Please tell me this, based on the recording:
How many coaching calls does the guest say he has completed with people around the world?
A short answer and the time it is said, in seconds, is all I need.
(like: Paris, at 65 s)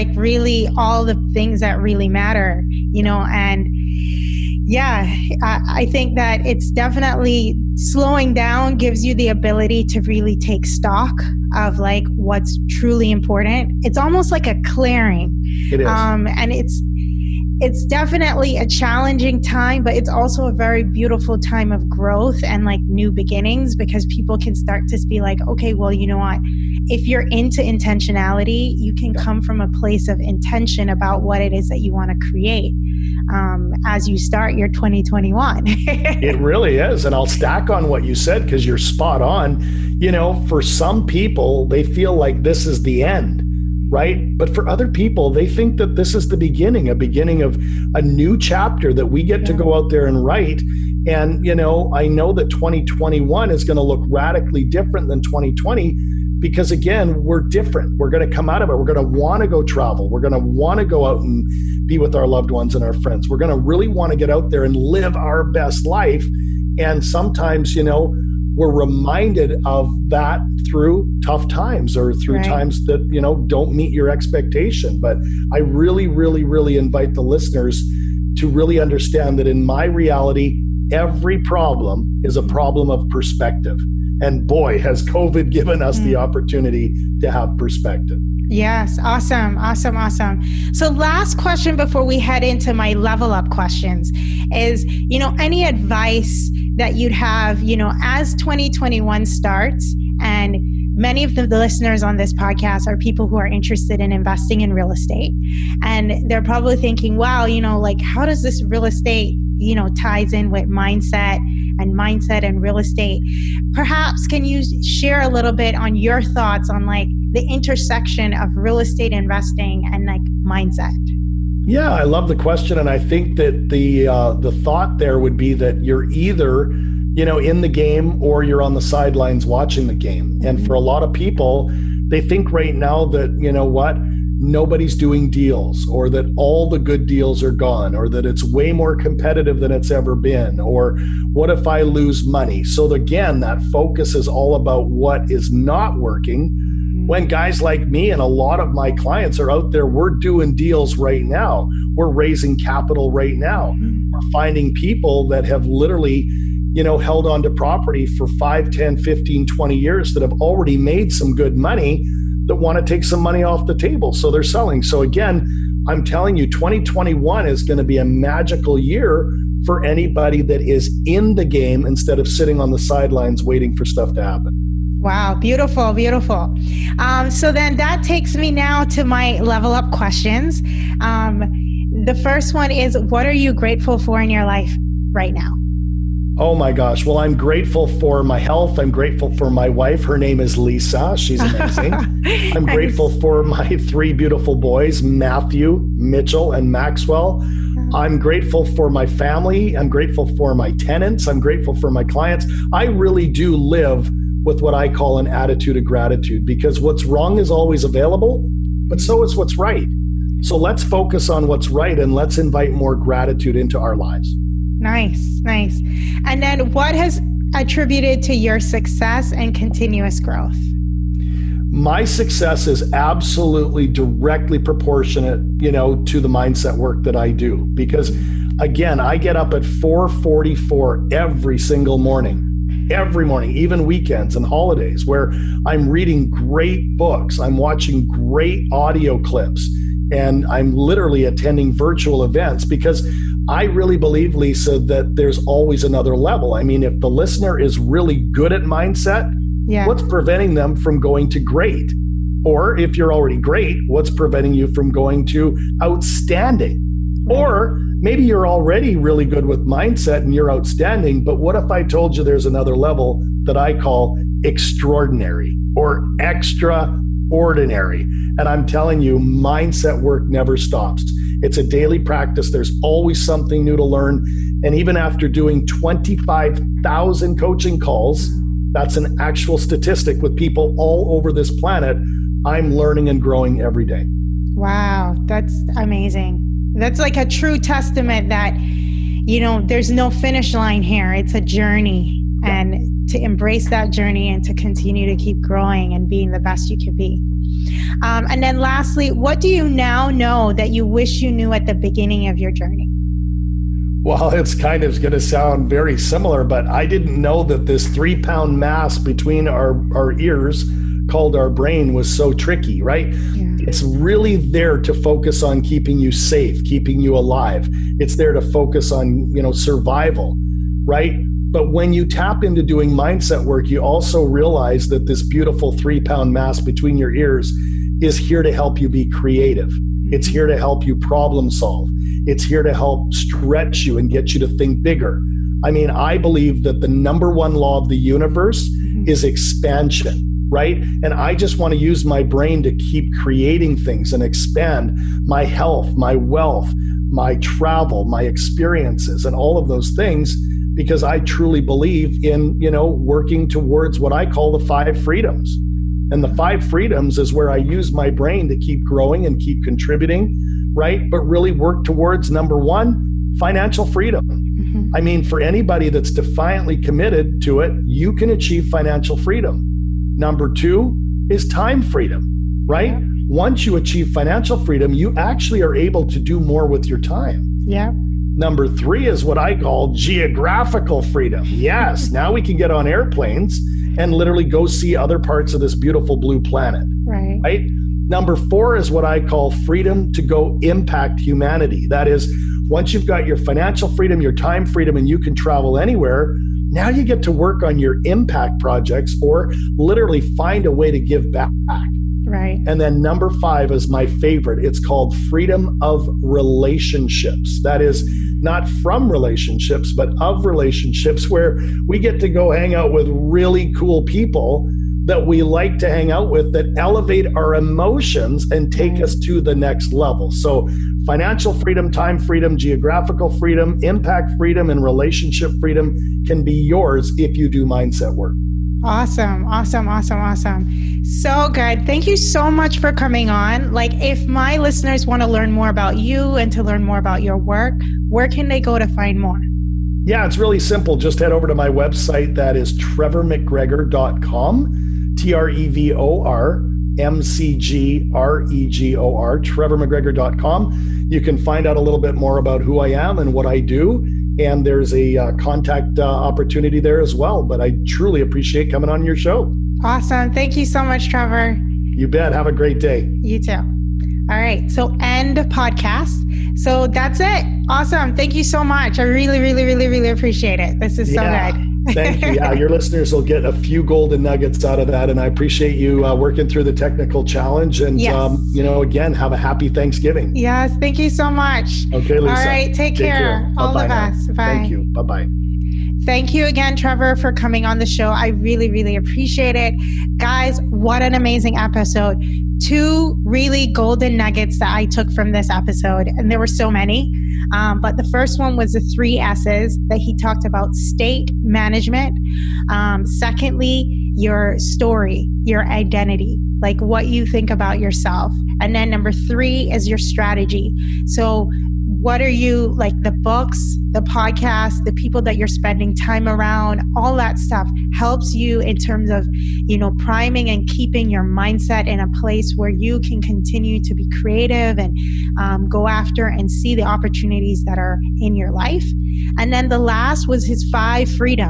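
25,000, at 275 s.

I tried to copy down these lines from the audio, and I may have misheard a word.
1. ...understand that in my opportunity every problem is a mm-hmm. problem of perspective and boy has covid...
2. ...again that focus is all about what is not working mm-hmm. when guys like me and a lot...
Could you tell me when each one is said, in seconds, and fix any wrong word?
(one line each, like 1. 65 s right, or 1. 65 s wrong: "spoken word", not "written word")
1. 78 s wrong: "reality", not "opportunity"
2. 142 s right.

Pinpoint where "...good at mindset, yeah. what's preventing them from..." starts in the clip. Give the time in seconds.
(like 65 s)
248 s.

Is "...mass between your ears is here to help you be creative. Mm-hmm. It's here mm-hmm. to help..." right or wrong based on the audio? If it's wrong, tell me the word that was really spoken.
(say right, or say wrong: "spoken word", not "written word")
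right.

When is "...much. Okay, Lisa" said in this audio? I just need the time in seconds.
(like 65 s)
481 s.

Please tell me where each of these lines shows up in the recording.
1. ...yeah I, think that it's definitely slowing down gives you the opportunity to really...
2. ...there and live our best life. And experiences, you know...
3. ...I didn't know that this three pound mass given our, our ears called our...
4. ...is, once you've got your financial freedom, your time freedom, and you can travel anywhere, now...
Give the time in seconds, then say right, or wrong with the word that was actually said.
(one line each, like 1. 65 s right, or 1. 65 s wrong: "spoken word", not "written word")
1. 4 s wrong: "ability", not "opportunity"
2. 64 s wrong: "sometimes", not "experiences"
3. 306 s wrong: "between", not "given"
4. 392 s right.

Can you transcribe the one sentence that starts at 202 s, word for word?
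I really do live with what I call an attitude of gratitude because what's wrong is always available, but so mm-hmm.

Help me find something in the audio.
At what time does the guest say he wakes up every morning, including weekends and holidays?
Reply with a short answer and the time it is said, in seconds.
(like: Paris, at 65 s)
4:44, at 229 s.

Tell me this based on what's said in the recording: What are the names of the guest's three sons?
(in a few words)
Matthew, Mitchell, and Maxwell.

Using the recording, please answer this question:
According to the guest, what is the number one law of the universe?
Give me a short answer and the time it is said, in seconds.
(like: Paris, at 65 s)
Expansion, at 339 s.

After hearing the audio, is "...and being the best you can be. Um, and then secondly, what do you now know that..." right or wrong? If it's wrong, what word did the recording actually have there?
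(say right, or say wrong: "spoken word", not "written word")
wrong: "lastly", not "secondly".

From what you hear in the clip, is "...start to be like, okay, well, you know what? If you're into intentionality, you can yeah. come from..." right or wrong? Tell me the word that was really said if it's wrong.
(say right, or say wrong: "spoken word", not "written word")
right.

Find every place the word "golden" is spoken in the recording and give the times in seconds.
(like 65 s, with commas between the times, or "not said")
473 s, 493 s.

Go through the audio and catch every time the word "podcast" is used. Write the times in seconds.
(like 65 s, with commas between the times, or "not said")
102 s, 465 s, 514 s.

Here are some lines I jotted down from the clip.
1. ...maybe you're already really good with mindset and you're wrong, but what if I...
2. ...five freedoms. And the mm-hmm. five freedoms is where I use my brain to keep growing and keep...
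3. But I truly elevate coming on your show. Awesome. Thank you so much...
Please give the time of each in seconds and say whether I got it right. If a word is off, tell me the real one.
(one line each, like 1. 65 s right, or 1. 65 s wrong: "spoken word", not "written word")
1. 258 s wrong: "outstanding", not "wrong"
2. 354 s right
3. 457 s wrong: "appreciate", not "elevate".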